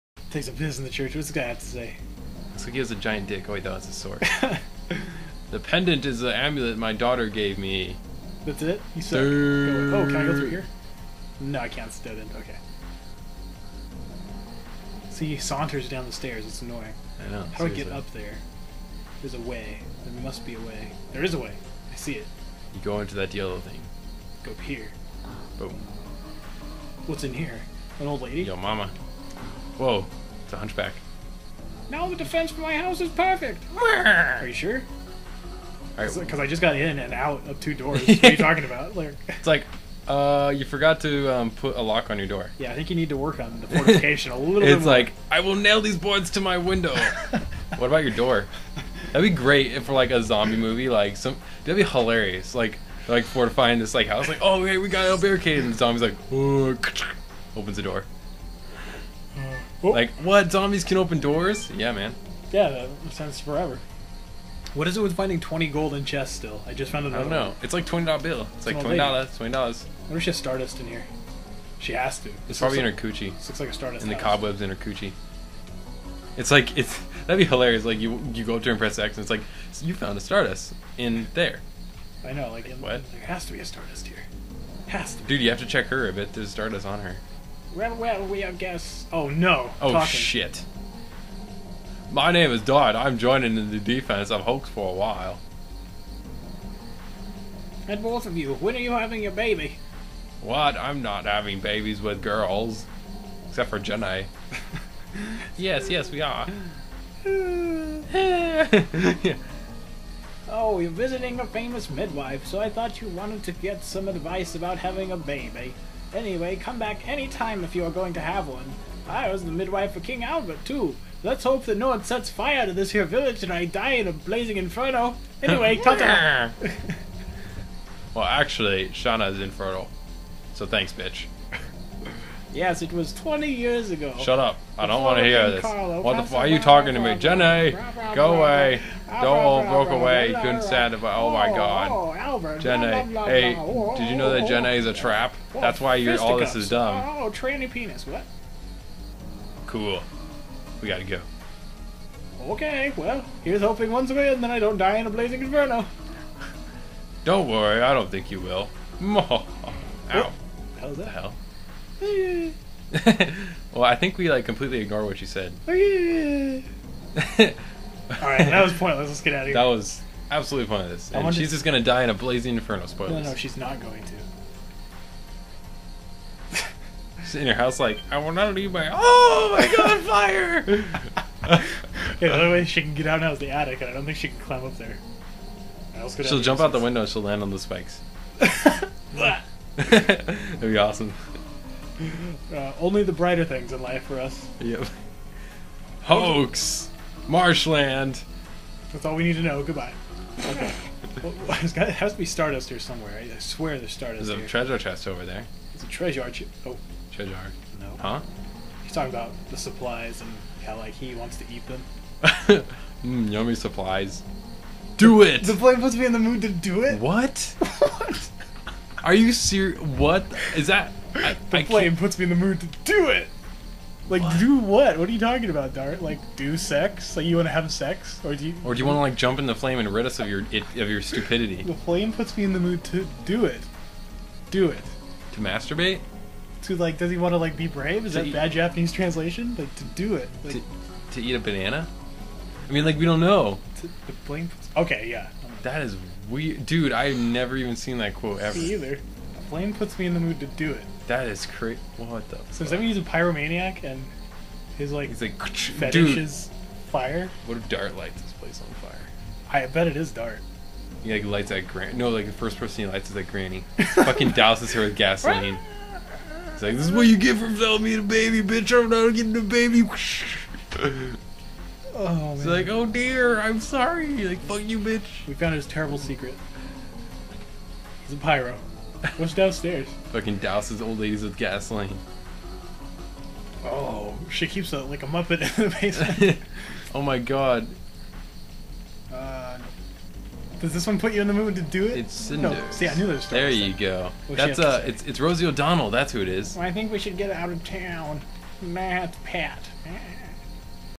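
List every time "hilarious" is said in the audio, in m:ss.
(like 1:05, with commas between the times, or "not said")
0:51, 1:17.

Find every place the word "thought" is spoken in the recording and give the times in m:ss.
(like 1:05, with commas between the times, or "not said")
0:03, 1:52.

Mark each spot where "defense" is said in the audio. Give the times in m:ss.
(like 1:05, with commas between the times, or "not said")
0:32, 1:33.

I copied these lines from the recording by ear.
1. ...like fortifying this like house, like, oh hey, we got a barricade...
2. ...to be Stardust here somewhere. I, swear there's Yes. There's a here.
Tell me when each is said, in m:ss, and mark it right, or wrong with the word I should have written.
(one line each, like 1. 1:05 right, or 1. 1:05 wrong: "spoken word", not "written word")
1. 0:53 right
2. 3:22 wrong: "Stardust", not "Yes".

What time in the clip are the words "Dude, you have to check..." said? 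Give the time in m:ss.
1:25.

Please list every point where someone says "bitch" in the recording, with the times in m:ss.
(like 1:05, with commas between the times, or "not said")
2:10, 4:28, 4:34.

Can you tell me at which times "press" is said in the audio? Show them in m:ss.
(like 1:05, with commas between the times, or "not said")
1:18.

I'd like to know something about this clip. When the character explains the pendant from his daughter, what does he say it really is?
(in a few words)
Amulet.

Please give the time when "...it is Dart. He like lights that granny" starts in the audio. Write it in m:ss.
4:19.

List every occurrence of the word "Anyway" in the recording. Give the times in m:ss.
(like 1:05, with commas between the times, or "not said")
1:56, 2:05.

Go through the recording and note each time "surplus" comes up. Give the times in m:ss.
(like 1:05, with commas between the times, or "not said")
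not said.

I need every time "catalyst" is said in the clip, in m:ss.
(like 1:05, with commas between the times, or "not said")
not said.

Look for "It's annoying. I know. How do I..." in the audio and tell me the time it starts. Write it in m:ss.
0:16.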